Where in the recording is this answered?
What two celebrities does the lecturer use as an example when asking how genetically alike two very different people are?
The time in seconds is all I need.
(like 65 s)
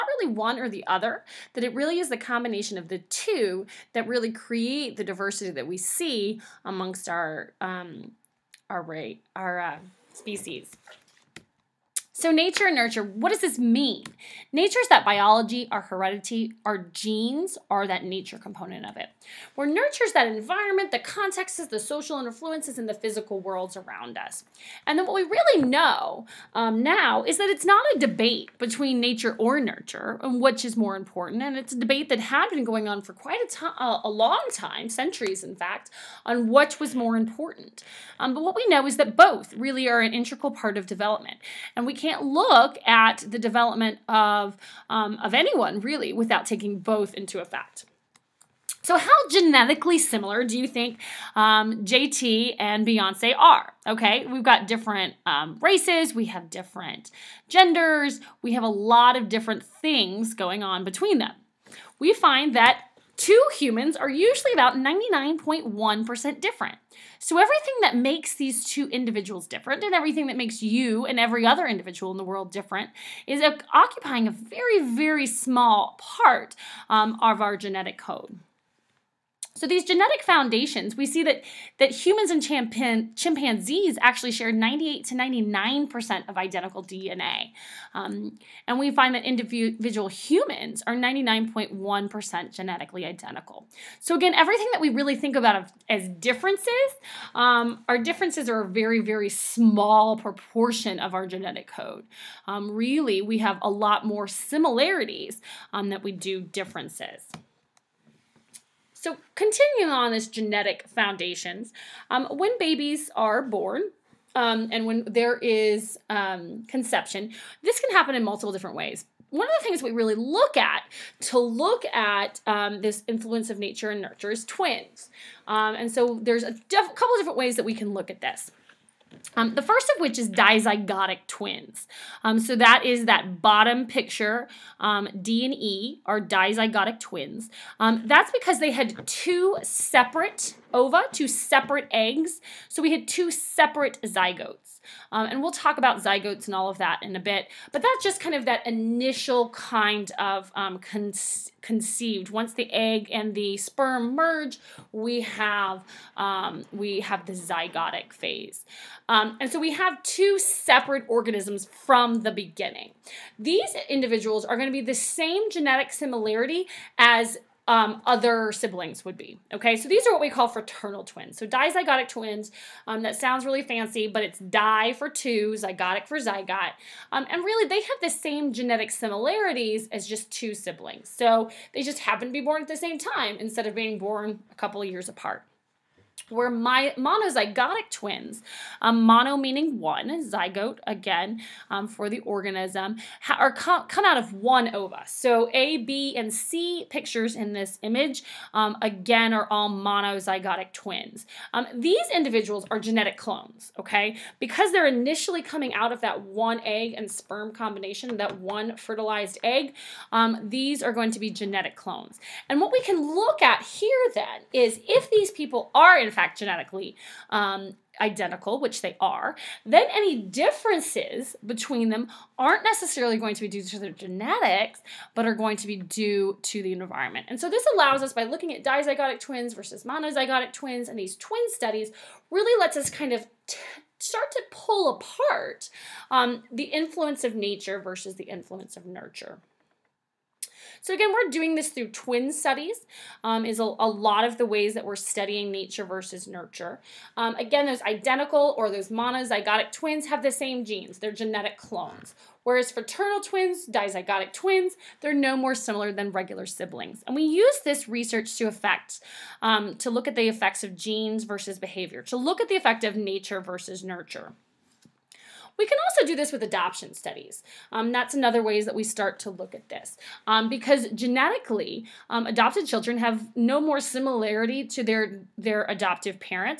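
51 s.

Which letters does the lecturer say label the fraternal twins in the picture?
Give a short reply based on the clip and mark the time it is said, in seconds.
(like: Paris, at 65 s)
D and E, at 135 s.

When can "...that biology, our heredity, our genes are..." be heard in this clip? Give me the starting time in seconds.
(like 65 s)
14 s.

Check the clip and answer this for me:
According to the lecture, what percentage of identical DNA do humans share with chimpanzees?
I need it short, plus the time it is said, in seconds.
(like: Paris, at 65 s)
98 to 99 percent, at 84 s.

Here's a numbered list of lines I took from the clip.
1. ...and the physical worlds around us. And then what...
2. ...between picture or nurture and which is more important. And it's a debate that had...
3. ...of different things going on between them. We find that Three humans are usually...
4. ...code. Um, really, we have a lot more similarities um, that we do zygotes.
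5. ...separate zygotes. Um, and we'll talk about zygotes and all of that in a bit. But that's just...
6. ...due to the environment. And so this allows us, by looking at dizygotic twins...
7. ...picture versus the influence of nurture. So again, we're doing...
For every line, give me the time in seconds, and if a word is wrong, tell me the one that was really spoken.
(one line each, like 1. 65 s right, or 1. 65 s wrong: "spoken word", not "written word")
1. 22 s right
2. 28 s wrong: "nature", not "picture"
3. 59 s wrong: "Two", not "Three"
4. 101 s wrong: "differences", not "zygotes"
5. 143 s right
6. 225 s right
7. 237 s wrong: "nature", not "picture".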